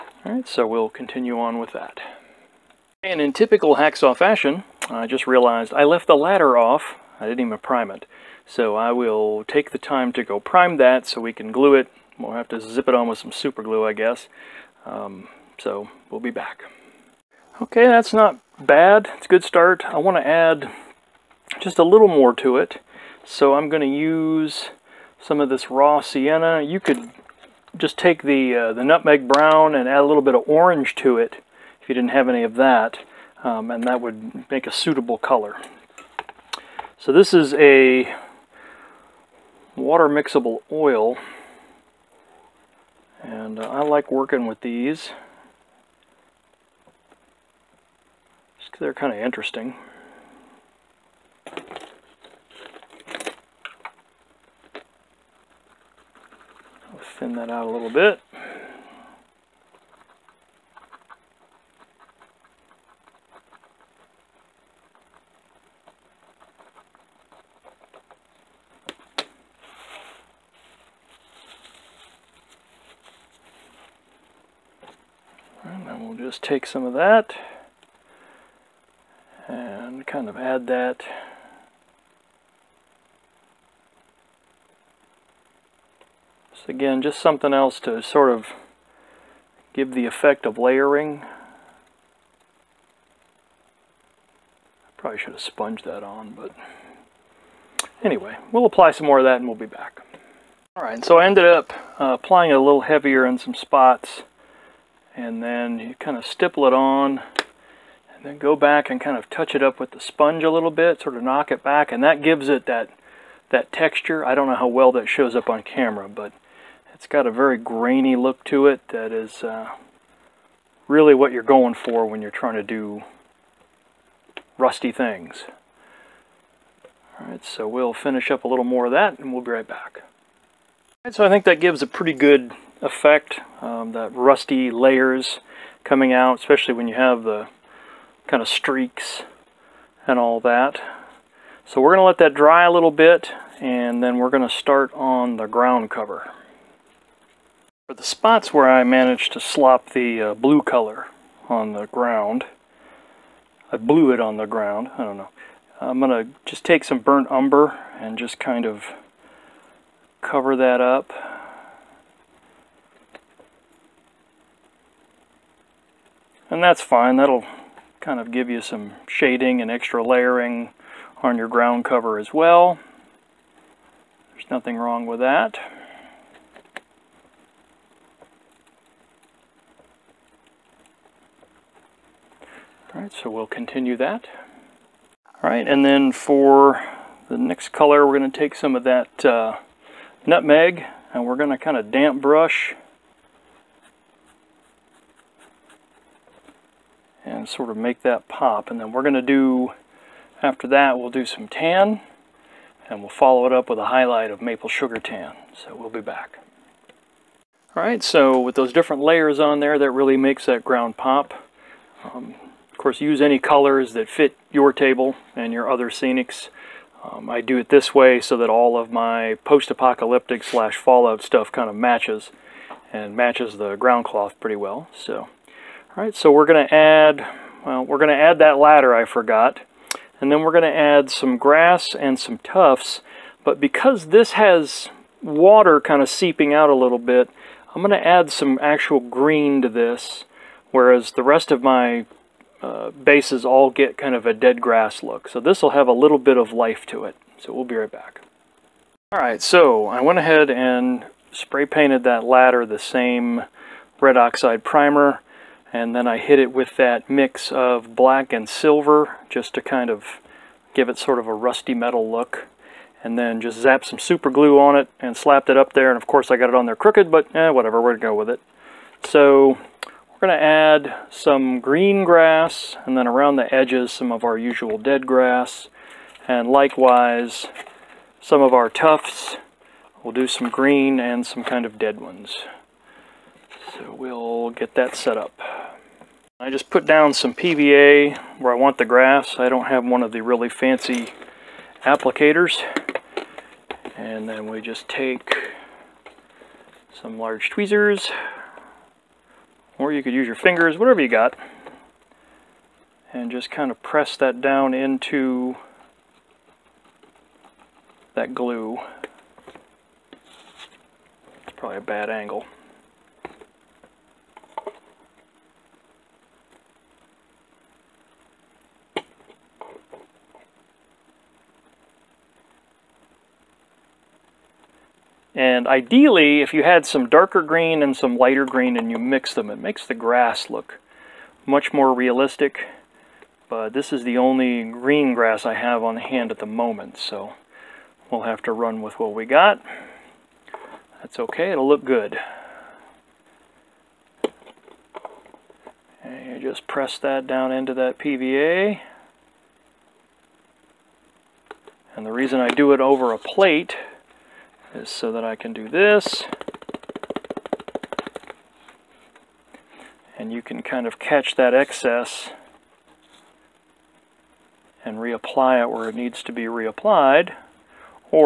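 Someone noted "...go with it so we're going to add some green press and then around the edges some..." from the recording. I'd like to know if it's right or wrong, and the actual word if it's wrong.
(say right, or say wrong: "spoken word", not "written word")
wrong: "grass", not "press".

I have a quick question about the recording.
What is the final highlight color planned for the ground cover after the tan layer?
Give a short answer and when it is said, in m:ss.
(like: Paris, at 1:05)
maple sugar tan, at 3:24.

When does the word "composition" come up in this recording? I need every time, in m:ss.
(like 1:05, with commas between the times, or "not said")
not said.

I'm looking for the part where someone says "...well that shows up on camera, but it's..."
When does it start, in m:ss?
1:54.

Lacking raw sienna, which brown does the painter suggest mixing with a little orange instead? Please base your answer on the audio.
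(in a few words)
nutmeg brown.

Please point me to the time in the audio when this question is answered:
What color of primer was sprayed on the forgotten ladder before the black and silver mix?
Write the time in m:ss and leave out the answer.
4:13.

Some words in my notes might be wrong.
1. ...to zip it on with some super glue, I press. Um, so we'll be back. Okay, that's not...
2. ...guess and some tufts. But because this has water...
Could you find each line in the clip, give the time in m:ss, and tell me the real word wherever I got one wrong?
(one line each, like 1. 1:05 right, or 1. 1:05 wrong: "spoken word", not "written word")
1. 0:12 wrong: "guess", not "press"
2. 3:51 wrong: "grass", not "guess".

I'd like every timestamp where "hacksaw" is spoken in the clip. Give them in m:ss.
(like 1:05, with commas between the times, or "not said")
0:03.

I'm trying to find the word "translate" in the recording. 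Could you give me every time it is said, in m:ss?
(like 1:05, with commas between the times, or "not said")
not said.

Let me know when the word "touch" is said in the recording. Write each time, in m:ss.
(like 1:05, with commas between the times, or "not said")
1:49.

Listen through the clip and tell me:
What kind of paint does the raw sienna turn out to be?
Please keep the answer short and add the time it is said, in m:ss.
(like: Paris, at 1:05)
water mixable oil, at 0:39.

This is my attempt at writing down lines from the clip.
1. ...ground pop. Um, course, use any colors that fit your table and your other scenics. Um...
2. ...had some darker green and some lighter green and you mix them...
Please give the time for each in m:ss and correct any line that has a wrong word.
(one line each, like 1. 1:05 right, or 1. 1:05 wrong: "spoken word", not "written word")
1. 3:30 right
2. 5:26 right.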